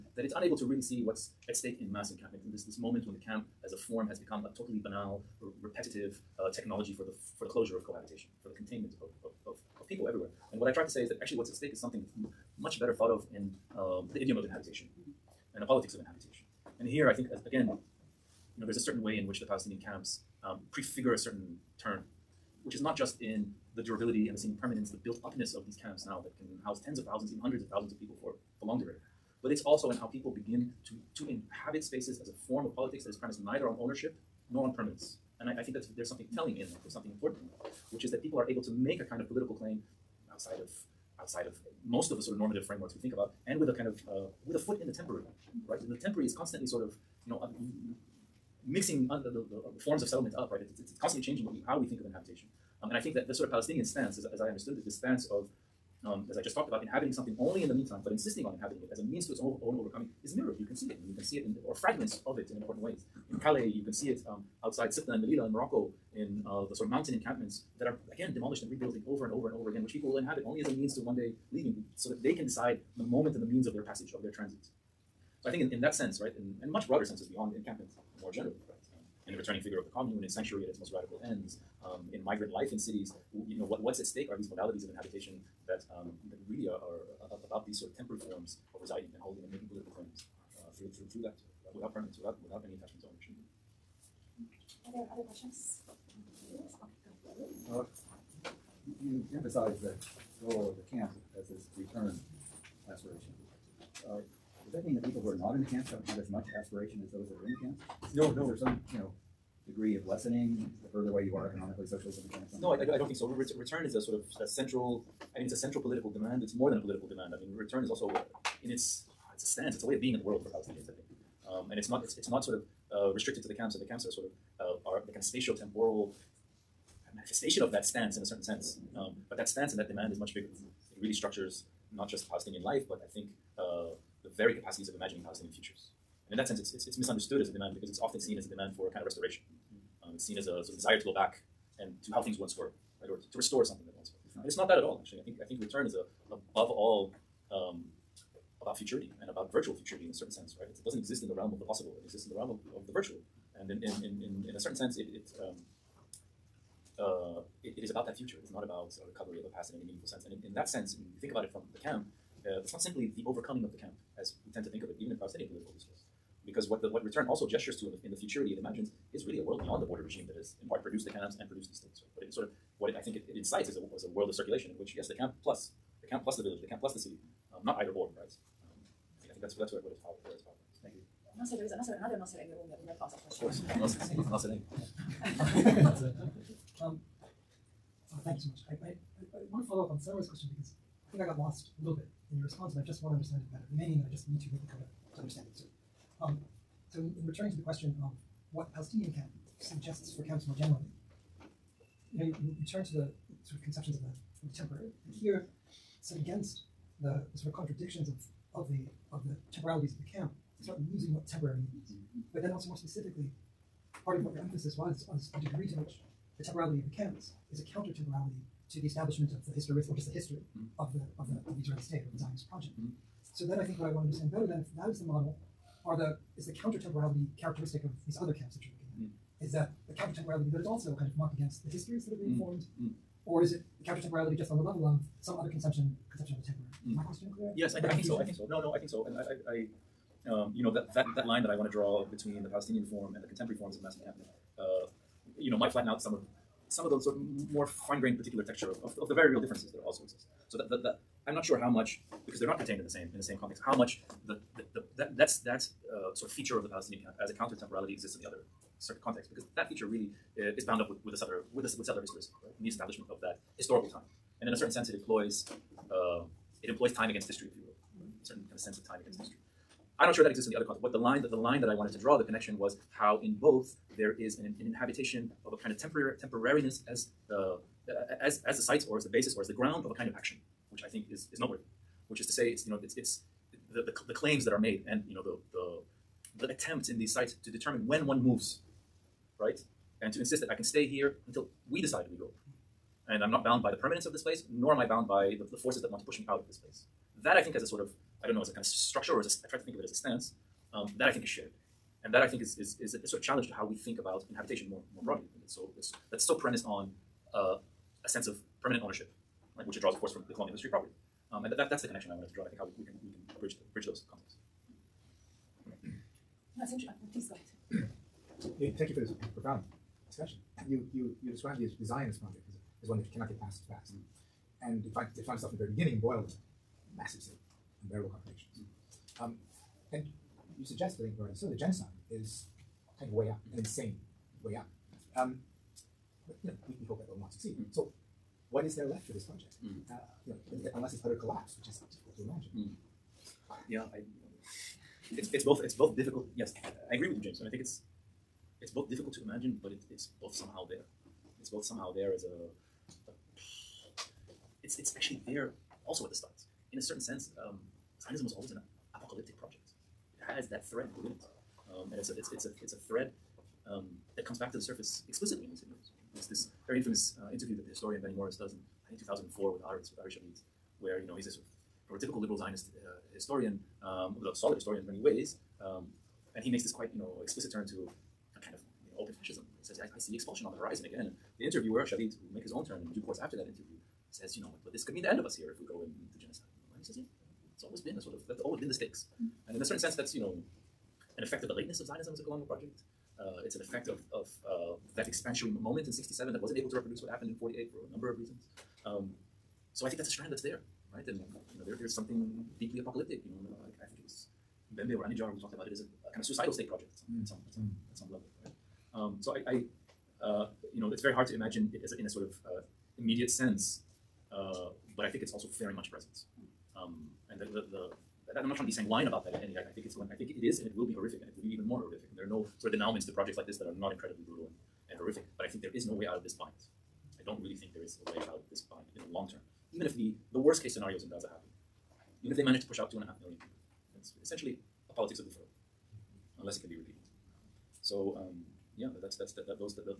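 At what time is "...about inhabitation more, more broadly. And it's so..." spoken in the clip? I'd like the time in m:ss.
5:03.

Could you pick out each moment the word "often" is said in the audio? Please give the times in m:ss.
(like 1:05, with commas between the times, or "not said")
2:17.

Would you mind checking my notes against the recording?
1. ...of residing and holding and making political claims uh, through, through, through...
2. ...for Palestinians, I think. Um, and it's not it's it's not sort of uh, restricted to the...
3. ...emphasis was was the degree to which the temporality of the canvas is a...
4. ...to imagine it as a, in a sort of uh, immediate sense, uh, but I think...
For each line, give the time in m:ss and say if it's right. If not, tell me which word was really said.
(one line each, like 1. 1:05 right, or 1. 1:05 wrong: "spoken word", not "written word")
1. 1:28 right
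2. 2:00 right
3. 3:34 right
4. 6:51 right.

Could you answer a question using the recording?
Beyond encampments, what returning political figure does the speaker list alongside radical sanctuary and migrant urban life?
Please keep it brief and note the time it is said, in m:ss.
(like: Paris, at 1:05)
the commune, at 1:19.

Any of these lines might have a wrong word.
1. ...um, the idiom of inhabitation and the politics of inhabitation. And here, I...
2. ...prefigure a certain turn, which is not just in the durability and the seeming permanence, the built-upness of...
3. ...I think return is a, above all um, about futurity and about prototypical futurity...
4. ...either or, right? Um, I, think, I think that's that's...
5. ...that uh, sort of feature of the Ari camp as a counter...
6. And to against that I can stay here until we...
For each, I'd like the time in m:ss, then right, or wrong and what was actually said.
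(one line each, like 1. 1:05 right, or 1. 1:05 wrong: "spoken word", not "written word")
1. 0:13 right
2. 0:20 right
3. 2:25 wrong: "virtual", not "prototypical"
4. 2:57 right
5. 4:15 wrong: "Palestinian", not "Ari"
6. 4:50 wrong: "insist", not "against".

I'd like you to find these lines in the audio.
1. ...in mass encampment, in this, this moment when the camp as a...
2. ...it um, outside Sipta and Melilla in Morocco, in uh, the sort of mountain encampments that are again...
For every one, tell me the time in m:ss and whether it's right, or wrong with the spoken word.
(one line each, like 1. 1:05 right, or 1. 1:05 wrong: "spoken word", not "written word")
1. 0:01 right
2. 1:04 right.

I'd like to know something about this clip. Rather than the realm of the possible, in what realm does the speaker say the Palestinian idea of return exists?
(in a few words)
the virtual.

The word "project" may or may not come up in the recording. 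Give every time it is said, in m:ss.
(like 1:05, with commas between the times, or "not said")
3:42, 5:22, 5:39, 5:59, 6:32, 6:46, 7:03.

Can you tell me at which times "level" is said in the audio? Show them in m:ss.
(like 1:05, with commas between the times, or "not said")
3:54, 6:48.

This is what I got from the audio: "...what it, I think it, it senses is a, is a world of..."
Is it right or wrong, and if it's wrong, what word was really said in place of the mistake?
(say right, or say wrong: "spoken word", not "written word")
wrong: "incites", not "senses".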